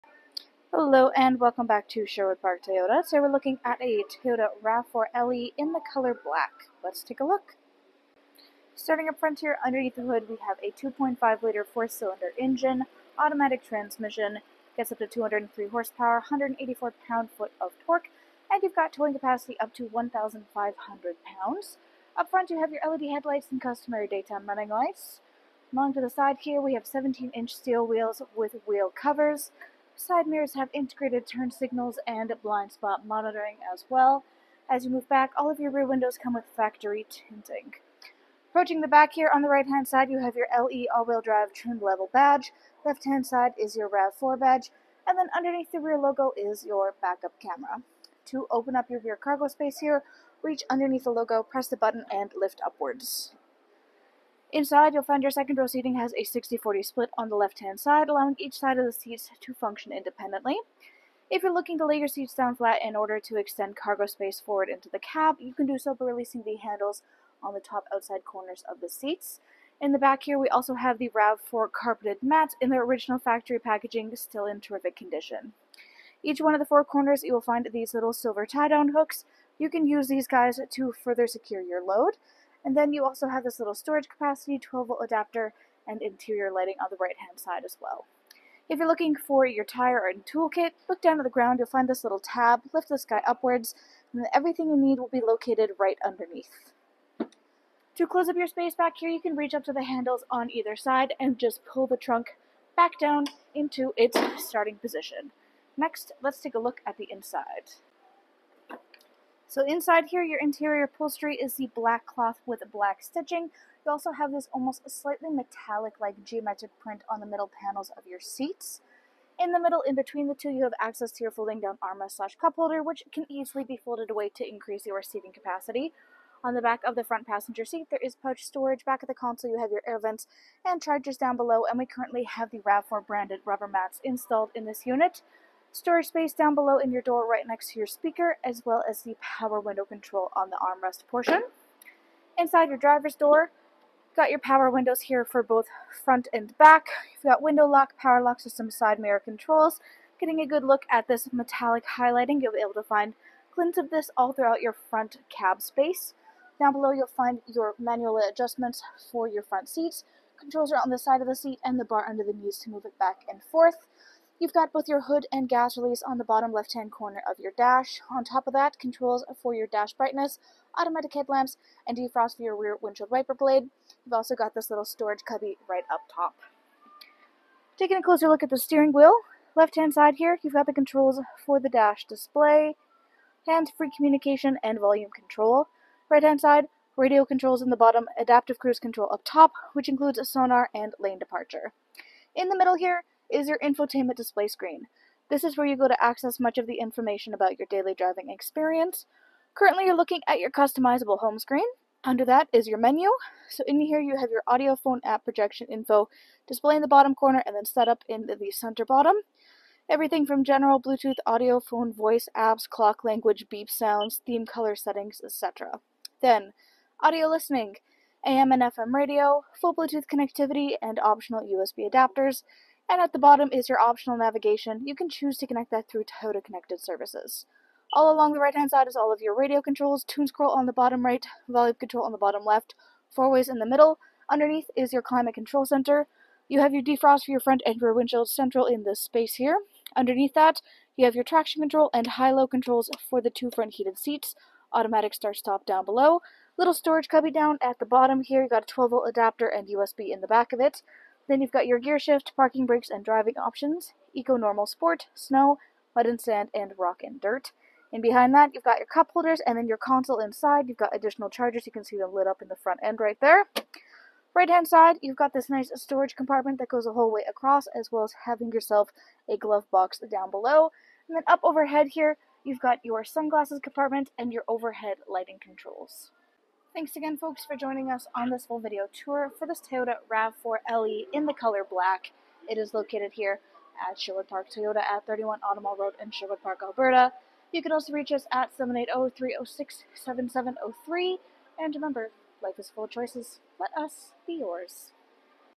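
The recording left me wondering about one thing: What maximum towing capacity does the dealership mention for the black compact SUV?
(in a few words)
1,500 pounds.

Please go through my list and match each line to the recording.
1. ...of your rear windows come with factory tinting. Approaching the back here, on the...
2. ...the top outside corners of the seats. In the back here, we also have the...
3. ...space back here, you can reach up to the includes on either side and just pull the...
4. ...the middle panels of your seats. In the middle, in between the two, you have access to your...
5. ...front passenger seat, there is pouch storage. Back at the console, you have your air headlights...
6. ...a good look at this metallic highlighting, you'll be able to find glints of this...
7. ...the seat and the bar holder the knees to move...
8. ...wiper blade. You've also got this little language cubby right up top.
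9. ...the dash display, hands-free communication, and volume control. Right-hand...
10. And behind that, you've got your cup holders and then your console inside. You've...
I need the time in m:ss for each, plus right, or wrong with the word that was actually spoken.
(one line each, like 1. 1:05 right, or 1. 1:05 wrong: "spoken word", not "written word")
1. 0:35 right
2. 1:07 right
3. 1:38 wrong: "handles", not "includes"
4. 1:57 right
5. 2:07 wrong: "vents", not "headlights"
6. 2:30 right
7. 2:41 wrong: "under", not "holder"
8. 2:53 wrong: "storage", not "language"
9. 3:01 right
10. 4:17 right.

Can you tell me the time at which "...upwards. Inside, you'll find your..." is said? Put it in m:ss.
0:52.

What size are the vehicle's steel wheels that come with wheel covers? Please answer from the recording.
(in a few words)
17-inch.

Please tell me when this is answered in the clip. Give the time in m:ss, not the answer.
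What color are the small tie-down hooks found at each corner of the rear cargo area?
1:18.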